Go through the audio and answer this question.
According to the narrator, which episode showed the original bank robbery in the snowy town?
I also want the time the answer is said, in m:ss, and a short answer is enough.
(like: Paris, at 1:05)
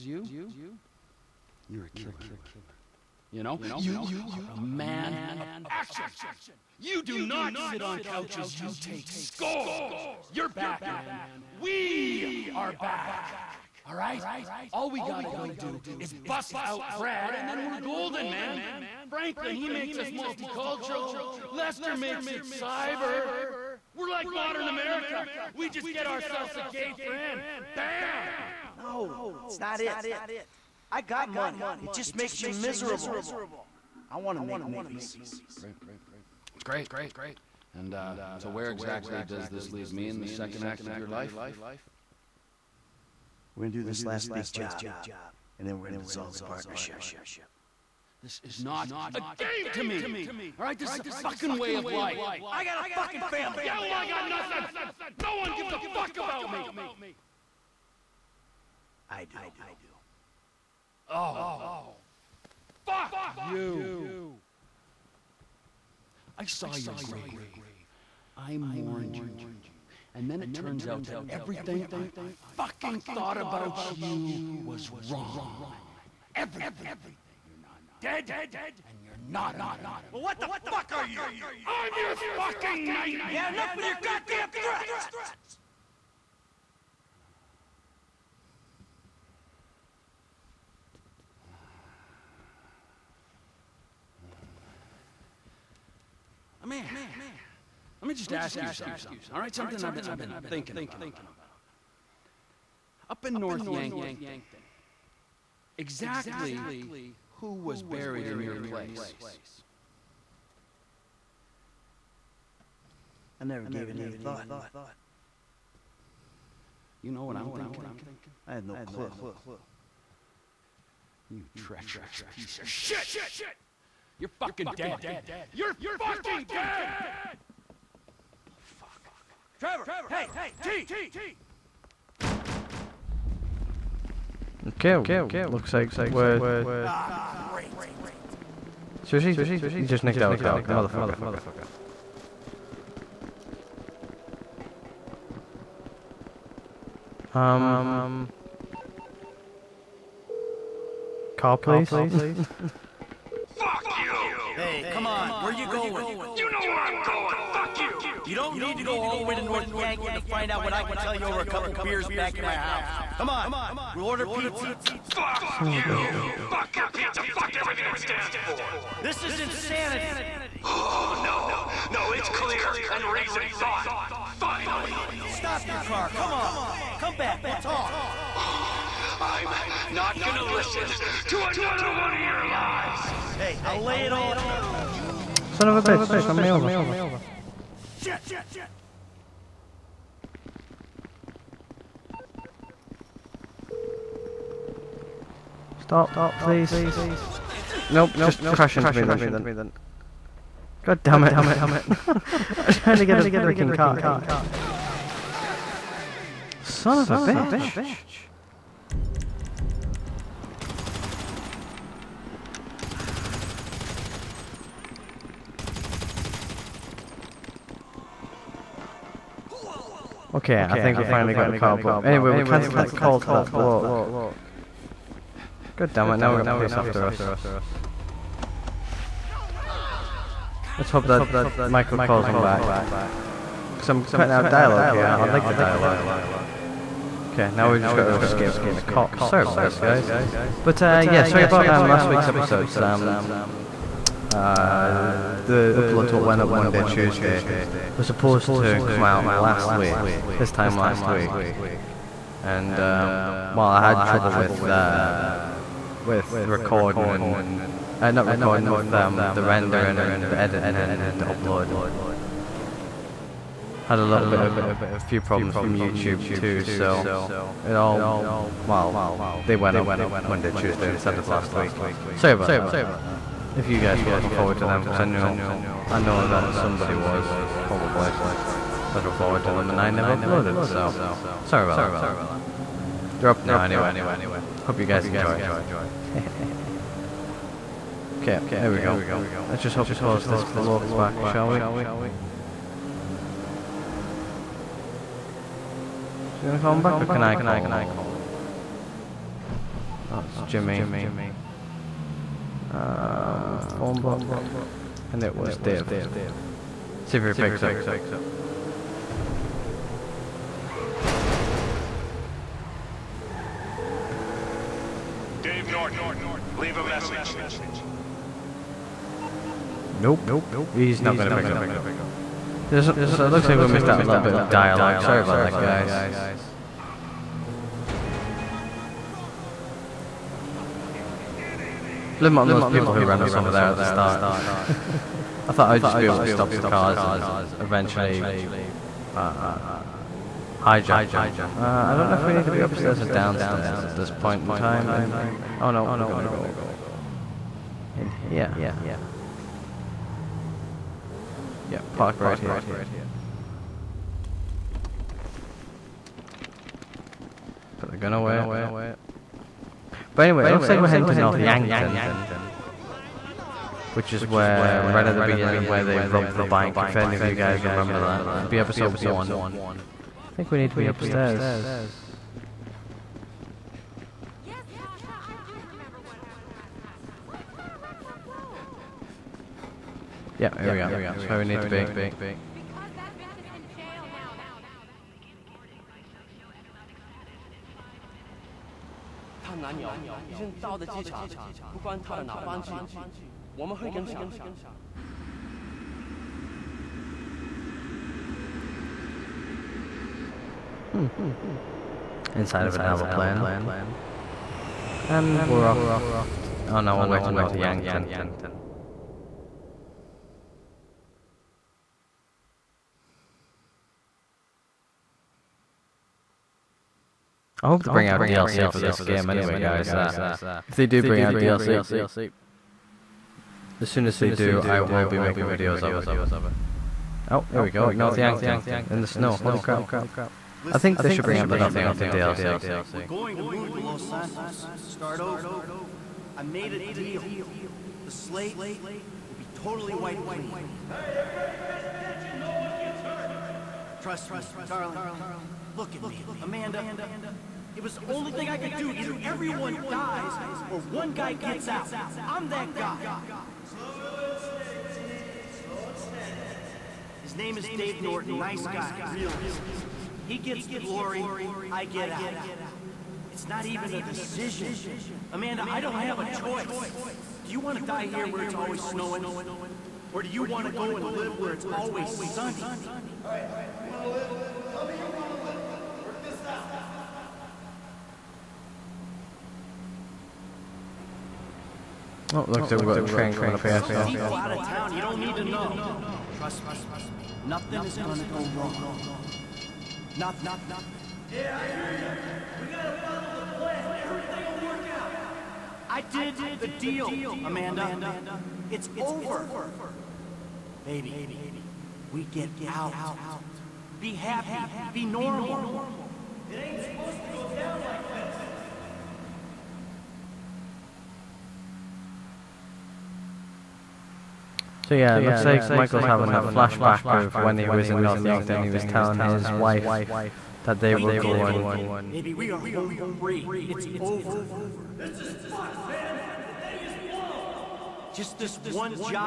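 Episode 1, at 6:08.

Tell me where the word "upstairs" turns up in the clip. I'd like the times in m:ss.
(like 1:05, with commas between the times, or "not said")
5:42, 6:10.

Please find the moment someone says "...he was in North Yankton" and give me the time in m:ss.
8:37.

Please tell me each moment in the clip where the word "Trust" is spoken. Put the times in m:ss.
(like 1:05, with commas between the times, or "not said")
7:24, 8:06.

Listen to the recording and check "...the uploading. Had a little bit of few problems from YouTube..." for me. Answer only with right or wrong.
right.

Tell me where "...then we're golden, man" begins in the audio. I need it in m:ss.
0:17.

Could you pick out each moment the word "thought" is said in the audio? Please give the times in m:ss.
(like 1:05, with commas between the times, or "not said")
1:12, 1:54, 2:53, 5:35.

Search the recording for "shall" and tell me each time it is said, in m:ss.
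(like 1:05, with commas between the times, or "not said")
4:51.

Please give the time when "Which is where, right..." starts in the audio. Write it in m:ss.
6:03.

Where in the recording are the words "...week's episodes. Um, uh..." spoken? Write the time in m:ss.
4:02.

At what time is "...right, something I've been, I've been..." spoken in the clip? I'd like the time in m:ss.
1:39.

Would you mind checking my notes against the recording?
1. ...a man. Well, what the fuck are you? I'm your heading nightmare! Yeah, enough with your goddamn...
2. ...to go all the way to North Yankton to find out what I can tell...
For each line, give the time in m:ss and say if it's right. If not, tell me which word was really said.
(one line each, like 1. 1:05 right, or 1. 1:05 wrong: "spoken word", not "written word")
1. 1:19 wrong: "fucking", not "heading"
2. 2:38 right.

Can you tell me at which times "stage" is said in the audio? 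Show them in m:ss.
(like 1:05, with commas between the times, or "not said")
not said.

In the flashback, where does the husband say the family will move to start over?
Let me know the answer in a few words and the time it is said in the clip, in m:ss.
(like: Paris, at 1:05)
Los Santos, at 7:13.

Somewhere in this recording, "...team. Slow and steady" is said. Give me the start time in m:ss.
7:35.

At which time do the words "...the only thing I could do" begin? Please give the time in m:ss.
7:27.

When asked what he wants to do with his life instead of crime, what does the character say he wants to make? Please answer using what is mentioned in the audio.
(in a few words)
Movies.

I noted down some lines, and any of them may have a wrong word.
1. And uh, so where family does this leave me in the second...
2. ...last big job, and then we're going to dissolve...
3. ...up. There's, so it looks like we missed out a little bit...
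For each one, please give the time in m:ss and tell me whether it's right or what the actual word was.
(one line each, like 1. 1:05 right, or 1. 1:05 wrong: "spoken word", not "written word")
1. 0:37 wrong: "exactly", not "family"
2. 0:44 right
3. 5:21 right.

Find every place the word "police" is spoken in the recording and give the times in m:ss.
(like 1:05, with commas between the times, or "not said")
3:46.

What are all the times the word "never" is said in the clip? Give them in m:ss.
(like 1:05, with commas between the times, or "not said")
1:53, 4:39.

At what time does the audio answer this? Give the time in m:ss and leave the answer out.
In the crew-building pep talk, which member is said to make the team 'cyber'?
0:21.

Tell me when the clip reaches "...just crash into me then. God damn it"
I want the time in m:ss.
3:18.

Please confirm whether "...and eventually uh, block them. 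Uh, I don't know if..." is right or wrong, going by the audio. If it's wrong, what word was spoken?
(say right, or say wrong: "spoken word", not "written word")
wrong: "hijack", not "block".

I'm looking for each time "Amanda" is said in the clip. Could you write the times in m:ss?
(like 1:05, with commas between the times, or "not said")
7:26, 7:45, 8:17.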